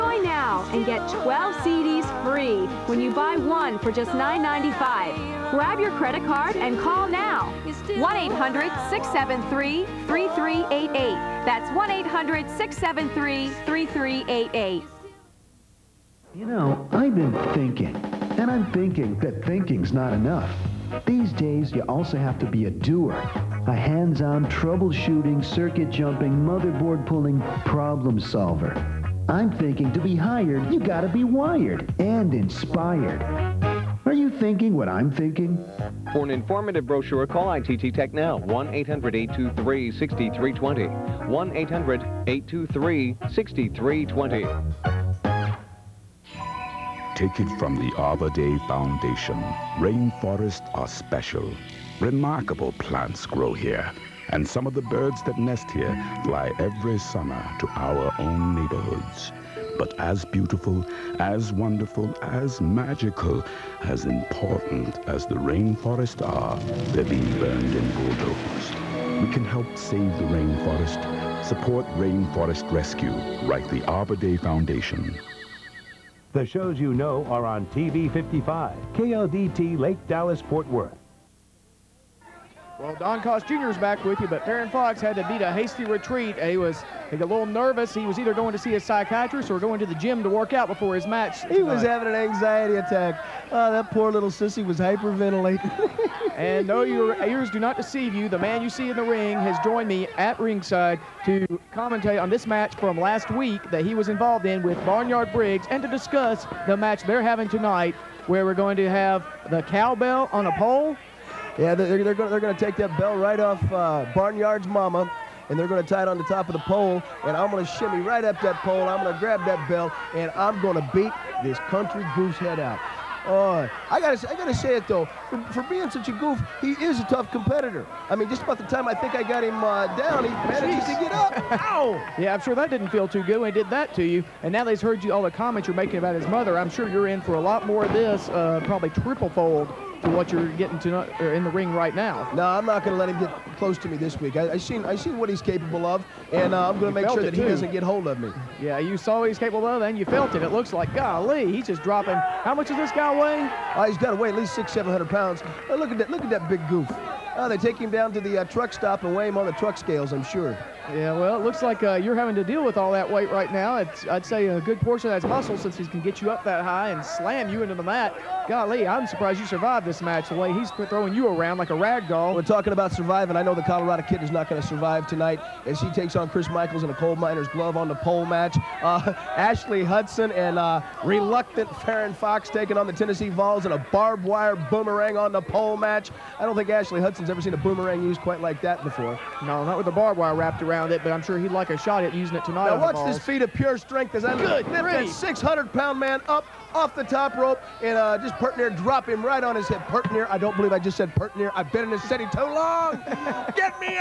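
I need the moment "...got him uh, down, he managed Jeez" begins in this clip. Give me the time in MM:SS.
02:09.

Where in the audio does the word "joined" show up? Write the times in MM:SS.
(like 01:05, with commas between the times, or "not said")
01:39.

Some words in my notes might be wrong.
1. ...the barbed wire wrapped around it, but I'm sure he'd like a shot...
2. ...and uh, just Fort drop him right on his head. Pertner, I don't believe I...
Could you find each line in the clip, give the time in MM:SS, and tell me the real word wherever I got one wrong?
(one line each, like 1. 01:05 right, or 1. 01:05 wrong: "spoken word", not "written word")
1. 03:09 right
2. 03:17 wrong: "Pertner", not "Fort".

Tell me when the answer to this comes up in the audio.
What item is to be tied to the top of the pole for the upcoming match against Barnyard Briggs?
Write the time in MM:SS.
01:49.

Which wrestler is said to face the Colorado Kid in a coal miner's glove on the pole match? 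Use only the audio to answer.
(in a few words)
Chris Michaels.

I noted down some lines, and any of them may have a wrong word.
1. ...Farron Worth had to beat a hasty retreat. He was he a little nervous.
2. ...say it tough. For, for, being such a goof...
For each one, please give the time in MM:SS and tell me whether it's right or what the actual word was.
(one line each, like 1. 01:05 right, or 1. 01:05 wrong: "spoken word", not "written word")
1. 01:24 wrong: "Fox", not "Worth"
2. 02:04 wrong: "though", not "tough".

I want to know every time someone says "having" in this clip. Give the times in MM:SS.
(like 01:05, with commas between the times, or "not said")
01:31, 01:47, 02:42.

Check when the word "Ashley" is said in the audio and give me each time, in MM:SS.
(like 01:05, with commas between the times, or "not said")
02:59, 03:06.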